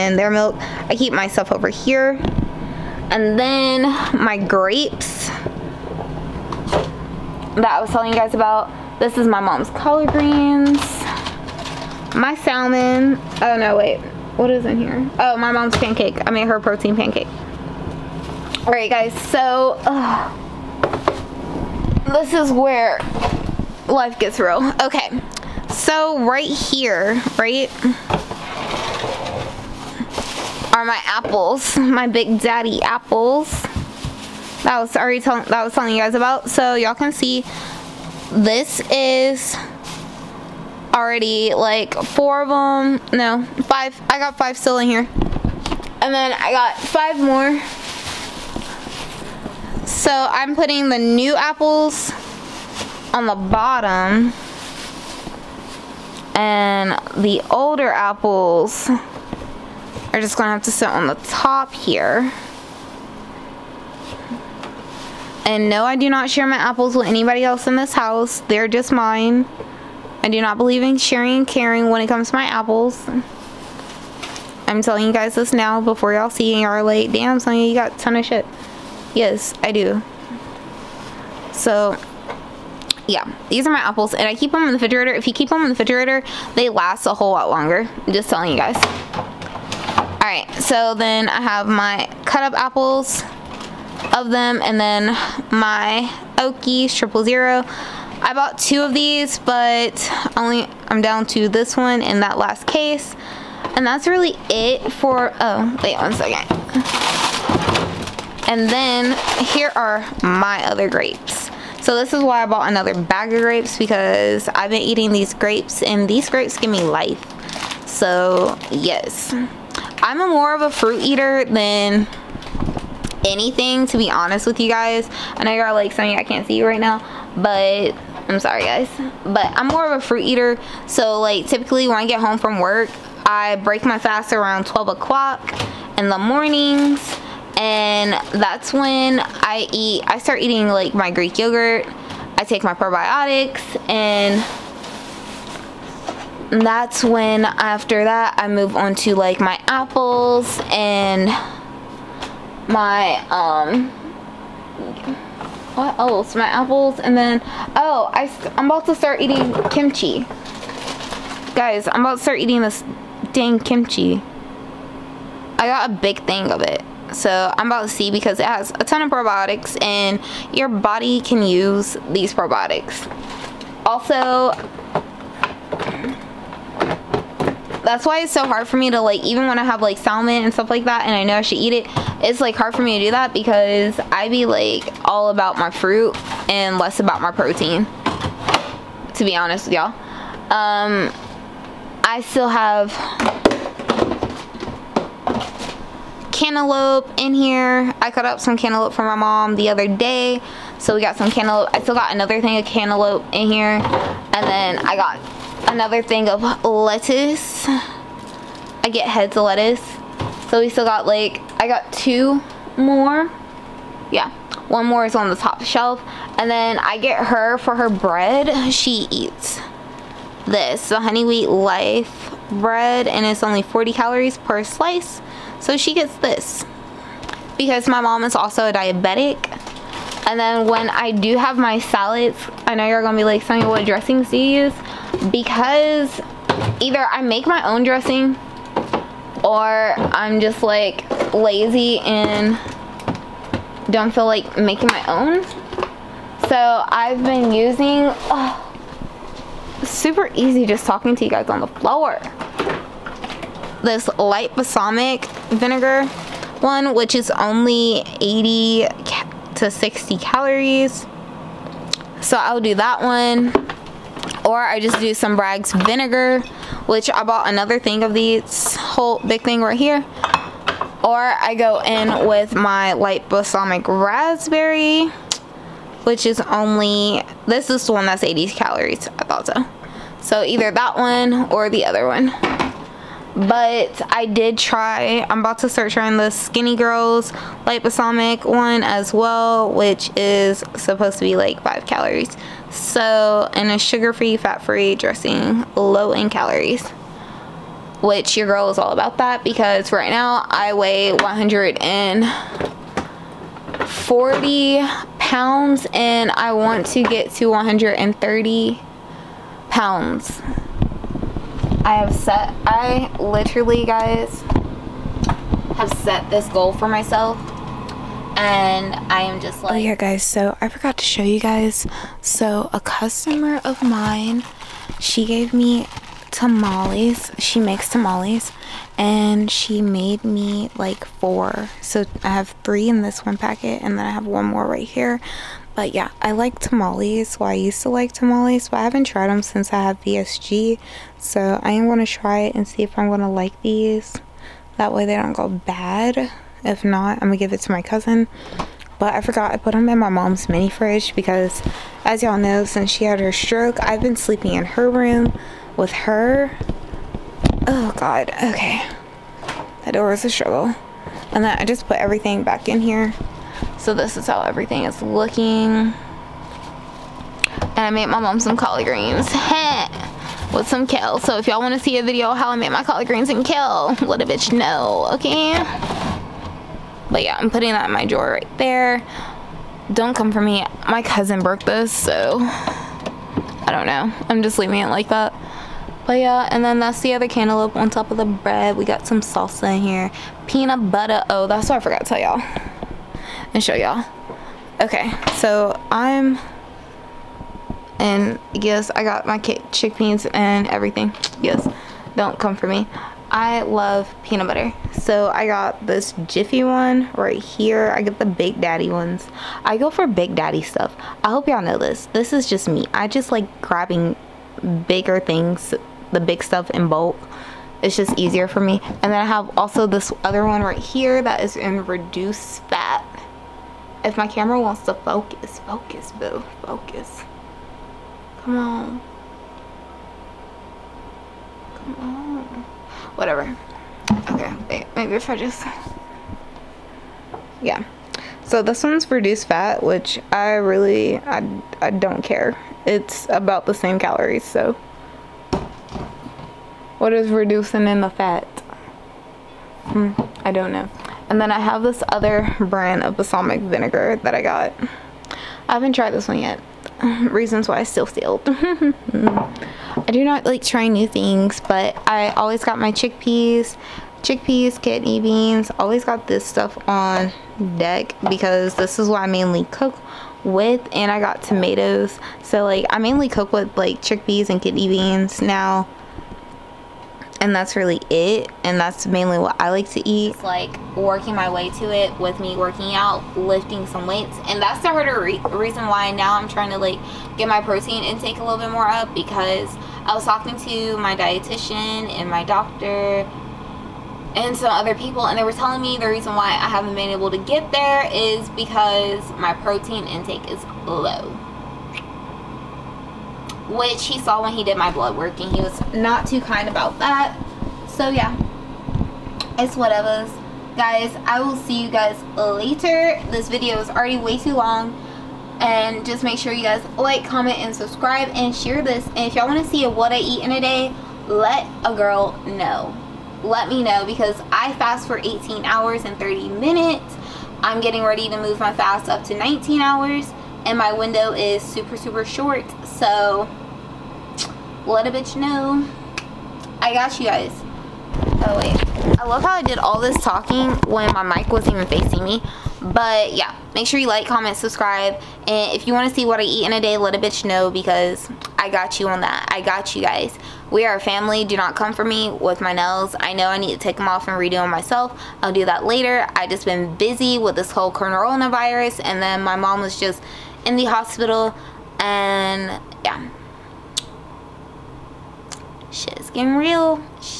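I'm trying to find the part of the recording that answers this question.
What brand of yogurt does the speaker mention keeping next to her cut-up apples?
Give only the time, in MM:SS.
01:36.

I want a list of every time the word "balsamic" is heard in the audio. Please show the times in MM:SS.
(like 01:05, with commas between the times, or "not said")
04:14, 04:33, 04:47, 07:33.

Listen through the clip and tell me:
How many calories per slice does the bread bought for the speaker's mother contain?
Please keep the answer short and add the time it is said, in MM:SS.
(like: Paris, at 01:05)
40, at 03:43.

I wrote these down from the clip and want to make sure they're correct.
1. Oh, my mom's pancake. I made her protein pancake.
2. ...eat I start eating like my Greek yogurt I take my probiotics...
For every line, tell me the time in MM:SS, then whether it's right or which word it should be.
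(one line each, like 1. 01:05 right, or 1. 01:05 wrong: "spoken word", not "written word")
1. 00:15 right
2. 02:19 right.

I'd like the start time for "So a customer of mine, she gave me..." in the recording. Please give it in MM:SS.
05:22.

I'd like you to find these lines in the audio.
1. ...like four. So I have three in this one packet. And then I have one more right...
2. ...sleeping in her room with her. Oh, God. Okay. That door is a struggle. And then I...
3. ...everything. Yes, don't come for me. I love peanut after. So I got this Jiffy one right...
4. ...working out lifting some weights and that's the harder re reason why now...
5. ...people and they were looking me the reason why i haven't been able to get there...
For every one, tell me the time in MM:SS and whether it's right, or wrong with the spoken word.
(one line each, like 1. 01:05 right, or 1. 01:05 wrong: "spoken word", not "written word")
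1. 05:30 right
2. 05:54 right
3. 06:40 wrong: "butter", not "after"
4. 08:02 right
5. 08:14 wrong: "telling", not "looking".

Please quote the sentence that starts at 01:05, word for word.
And no, I do not share my apples with anybody else in this house.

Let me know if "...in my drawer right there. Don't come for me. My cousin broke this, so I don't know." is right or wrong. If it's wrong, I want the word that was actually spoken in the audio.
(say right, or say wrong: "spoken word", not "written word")
right.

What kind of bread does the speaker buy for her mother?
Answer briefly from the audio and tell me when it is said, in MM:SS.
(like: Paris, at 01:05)
honey wheat life bread, at 03:41.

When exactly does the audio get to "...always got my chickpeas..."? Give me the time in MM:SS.
07:42.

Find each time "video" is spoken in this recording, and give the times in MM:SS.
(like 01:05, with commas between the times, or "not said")
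06:12, 08:33.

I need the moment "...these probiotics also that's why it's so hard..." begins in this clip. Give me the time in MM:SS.
02:52.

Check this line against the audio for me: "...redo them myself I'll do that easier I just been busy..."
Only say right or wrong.
wrong.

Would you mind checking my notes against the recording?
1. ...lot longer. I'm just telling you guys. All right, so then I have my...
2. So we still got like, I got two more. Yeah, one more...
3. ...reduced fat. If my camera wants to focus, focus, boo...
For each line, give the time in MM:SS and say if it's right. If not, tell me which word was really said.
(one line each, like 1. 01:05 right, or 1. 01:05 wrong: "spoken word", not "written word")
1. 01:27 right
2. 03:30 right
3. 07:01 right.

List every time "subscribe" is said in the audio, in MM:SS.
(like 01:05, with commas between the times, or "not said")
08:37, 09:04.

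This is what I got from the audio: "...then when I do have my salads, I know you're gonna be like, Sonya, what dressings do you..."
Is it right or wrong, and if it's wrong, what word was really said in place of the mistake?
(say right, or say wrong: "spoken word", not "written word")
right.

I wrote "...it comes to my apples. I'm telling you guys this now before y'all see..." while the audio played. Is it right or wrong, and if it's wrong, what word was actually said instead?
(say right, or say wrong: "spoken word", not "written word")
right.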